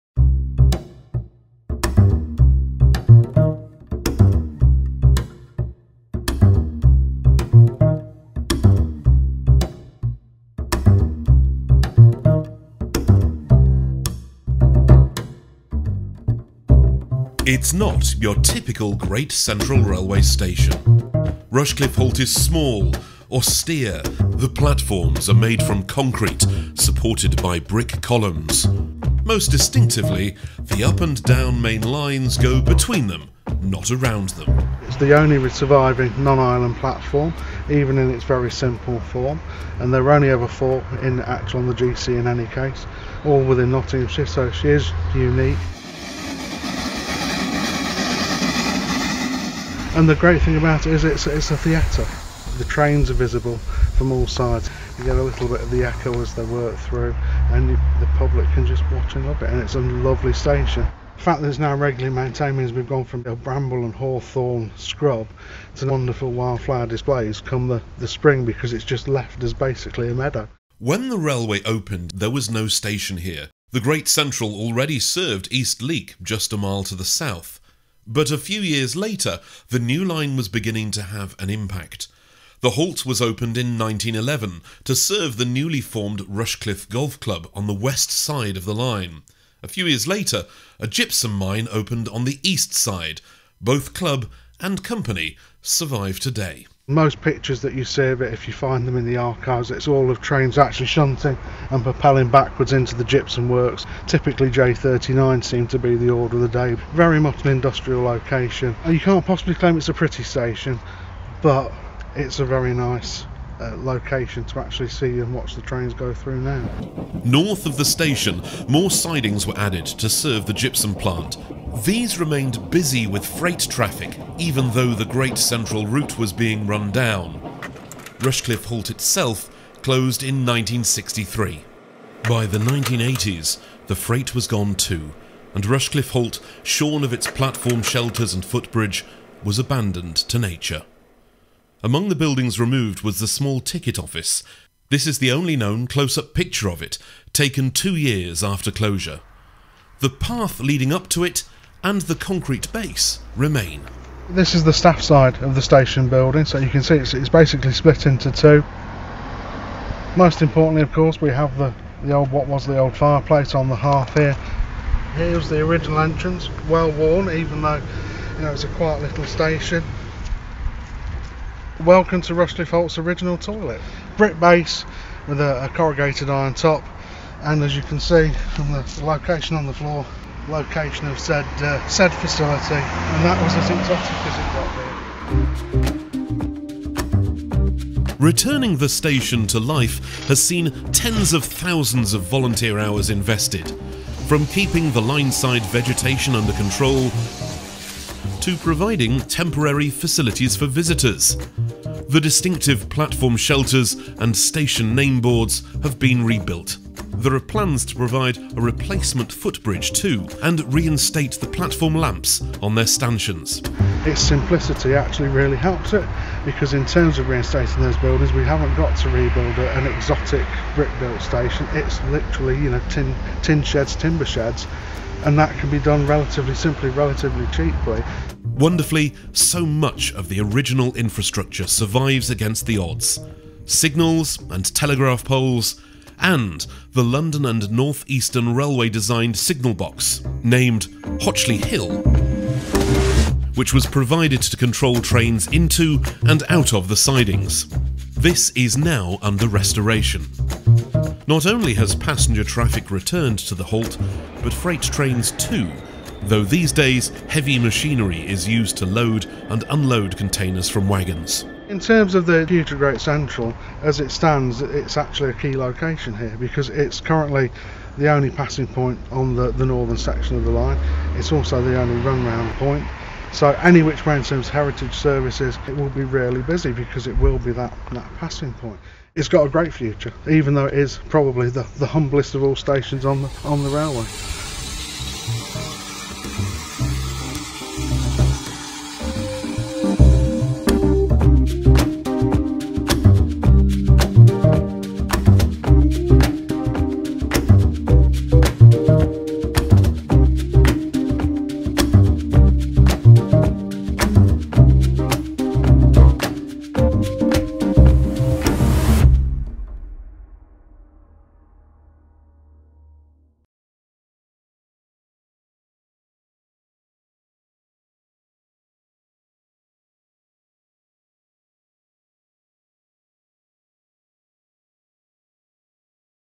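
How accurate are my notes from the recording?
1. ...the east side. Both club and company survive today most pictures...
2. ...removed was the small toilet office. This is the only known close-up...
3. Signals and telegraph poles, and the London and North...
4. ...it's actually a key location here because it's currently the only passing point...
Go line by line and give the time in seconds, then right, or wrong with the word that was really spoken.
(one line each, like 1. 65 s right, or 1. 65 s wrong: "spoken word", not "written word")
1. 92 s right
2. 142 s wrong: "ticket", not "toilet"
3. 233 s right
4. 264 s right.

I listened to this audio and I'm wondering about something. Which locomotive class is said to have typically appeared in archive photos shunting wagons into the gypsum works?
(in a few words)
J39.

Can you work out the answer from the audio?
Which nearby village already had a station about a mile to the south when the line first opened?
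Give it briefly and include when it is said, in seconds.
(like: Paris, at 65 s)
East Leake, at 75 s.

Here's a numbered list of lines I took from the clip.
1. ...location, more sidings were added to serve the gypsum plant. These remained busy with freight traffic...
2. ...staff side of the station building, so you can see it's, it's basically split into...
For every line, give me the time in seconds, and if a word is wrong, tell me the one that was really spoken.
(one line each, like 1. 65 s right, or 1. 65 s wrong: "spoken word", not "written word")
1. 117 s wrong: "station", not "location"
2. 154 s right.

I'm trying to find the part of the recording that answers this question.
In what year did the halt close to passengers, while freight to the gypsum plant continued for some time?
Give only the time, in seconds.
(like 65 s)
130 s.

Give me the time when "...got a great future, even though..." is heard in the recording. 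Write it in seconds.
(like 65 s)
279 s.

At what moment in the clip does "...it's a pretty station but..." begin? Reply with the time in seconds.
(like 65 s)
109 s.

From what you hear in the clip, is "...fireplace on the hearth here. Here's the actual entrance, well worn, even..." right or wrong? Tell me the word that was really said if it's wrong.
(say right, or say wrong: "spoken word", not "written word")
wrong: "original", not "actual".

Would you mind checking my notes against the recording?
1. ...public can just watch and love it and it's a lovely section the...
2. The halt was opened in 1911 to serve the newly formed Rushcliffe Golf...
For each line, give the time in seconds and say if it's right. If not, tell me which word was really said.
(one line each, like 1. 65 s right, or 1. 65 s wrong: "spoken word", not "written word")
1. 58 s wrong: "station", not "section"
2. 82 s right.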